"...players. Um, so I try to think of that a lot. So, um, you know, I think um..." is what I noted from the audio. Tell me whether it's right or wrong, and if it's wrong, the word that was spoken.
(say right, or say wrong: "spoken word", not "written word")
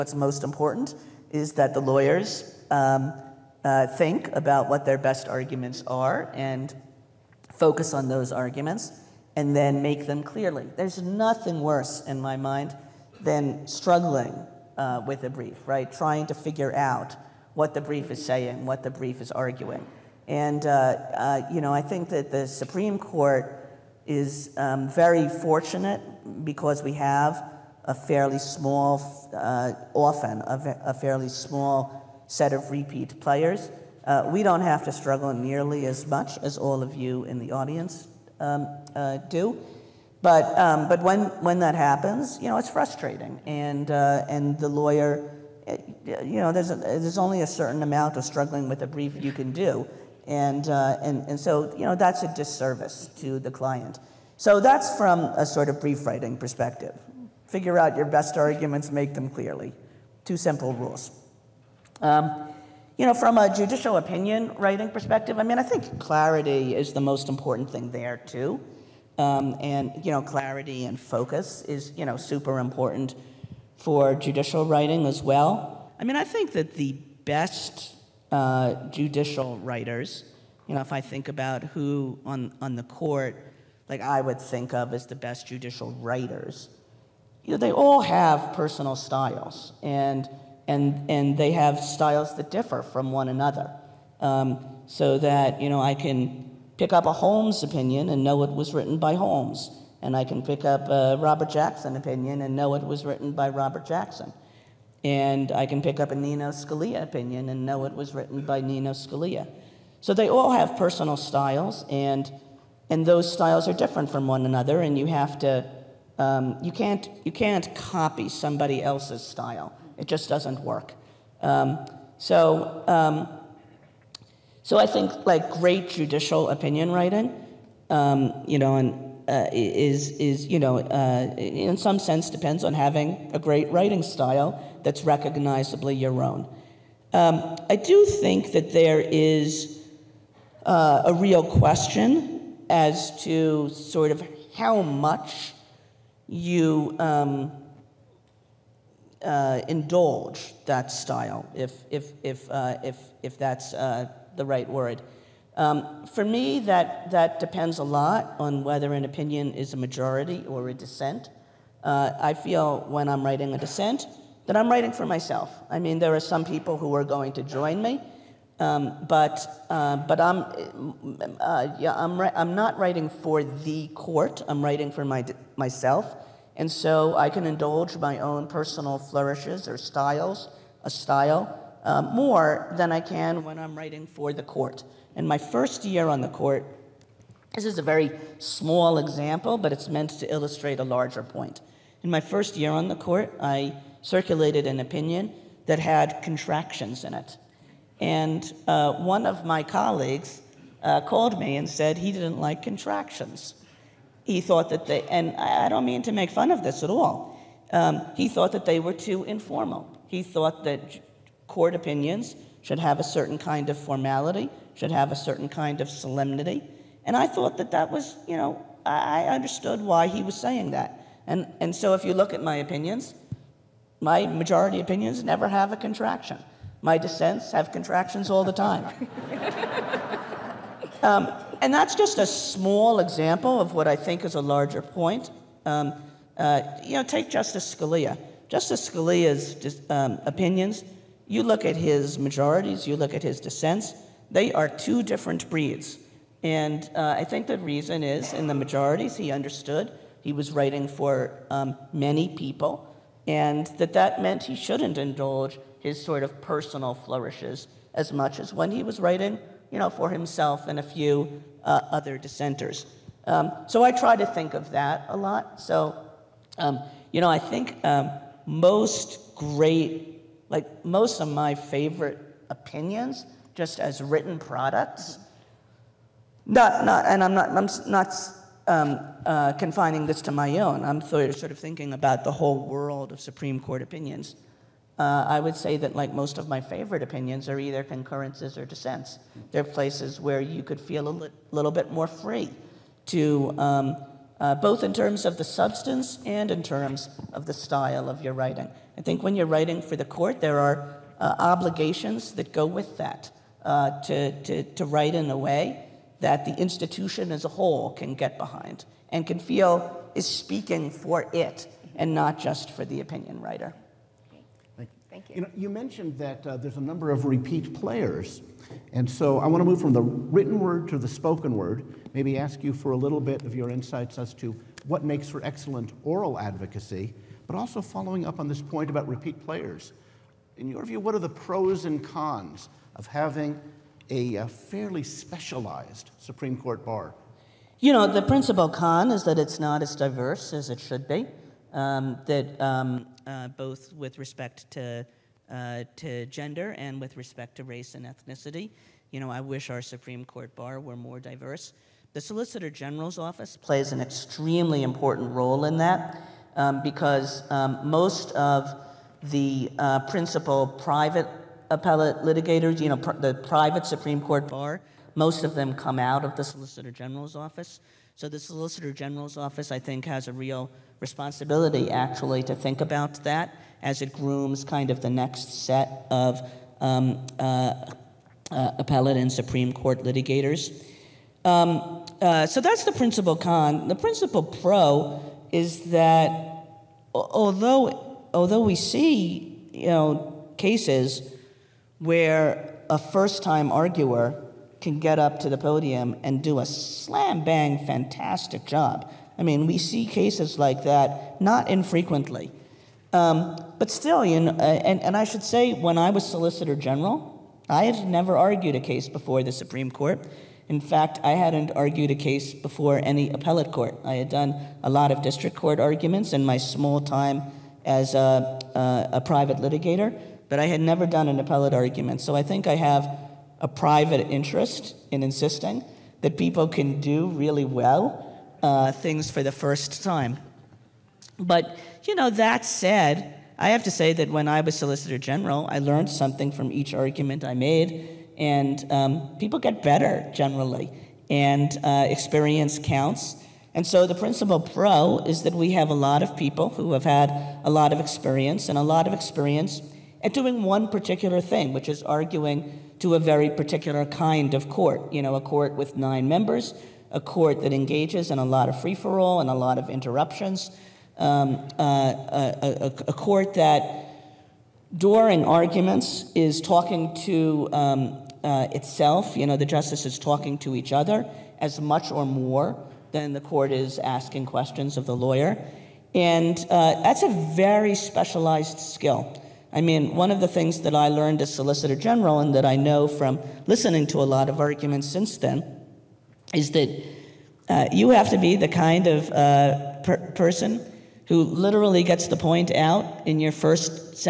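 wrong: "dissenters", not "players".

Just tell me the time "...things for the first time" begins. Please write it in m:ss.
7:08.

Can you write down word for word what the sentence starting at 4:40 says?
I'm sort of thinking about the whole world of Supreme Court opinions.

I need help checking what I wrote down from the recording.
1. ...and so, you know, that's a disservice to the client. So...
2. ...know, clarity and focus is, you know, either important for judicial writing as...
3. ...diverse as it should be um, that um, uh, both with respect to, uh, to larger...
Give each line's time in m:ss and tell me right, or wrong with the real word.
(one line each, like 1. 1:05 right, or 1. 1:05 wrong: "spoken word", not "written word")
1. 0:51 right
2. 1:10 wrong: "super", not "either"
3. 5:39 wrong: "gender", not "larger".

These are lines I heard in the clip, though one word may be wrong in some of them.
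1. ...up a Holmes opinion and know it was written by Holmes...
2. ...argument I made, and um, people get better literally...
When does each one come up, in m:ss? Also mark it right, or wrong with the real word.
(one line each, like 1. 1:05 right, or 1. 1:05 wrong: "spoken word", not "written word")
1. 1:36 right
2. 7:16 wrong: "generally", not "literally".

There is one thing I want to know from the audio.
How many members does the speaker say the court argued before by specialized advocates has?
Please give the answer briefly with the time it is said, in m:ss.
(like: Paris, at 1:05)
9, at 7:35.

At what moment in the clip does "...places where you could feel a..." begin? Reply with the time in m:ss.
4:49.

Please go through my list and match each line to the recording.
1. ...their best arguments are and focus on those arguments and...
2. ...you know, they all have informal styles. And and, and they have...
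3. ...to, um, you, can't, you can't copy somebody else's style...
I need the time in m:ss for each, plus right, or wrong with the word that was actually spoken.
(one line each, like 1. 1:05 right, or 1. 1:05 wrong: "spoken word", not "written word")
1. 0:04 right
2. 1:27 wrong: "personal", not "informal"
3. 1:55 right.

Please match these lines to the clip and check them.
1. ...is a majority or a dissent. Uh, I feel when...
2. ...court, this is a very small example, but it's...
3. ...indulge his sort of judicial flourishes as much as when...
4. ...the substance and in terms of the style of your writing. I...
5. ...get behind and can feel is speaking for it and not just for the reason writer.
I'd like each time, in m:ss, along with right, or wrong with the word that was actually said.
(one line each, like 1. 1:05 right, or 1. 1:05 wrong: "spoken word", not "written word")
1. 2:39 right
2. 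3:06 right
3. 4:14 wrong: "personal", not "judicial"
4. 4:55 right
5. 5:08 wrong: "opinion", not "reason".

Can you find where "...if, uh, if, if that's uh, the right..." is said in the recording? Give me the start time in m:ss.
2:32.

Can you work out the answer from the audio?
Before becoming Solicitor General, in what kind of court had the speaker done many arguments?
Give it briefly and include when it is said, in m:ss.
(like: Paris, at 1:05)
District court, at 6:55.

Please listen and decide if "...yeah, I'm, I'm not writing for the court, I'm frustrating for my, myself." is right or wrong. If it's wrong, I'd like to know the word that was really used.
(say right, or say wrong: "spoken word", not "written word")
wrong: "writing", not "frustrating".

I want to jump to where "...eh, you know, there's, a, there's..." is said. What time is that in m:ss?
0:46.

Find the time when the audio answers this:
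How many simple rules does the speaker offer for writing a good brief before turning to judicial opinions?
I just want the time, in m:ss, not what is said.
1:00.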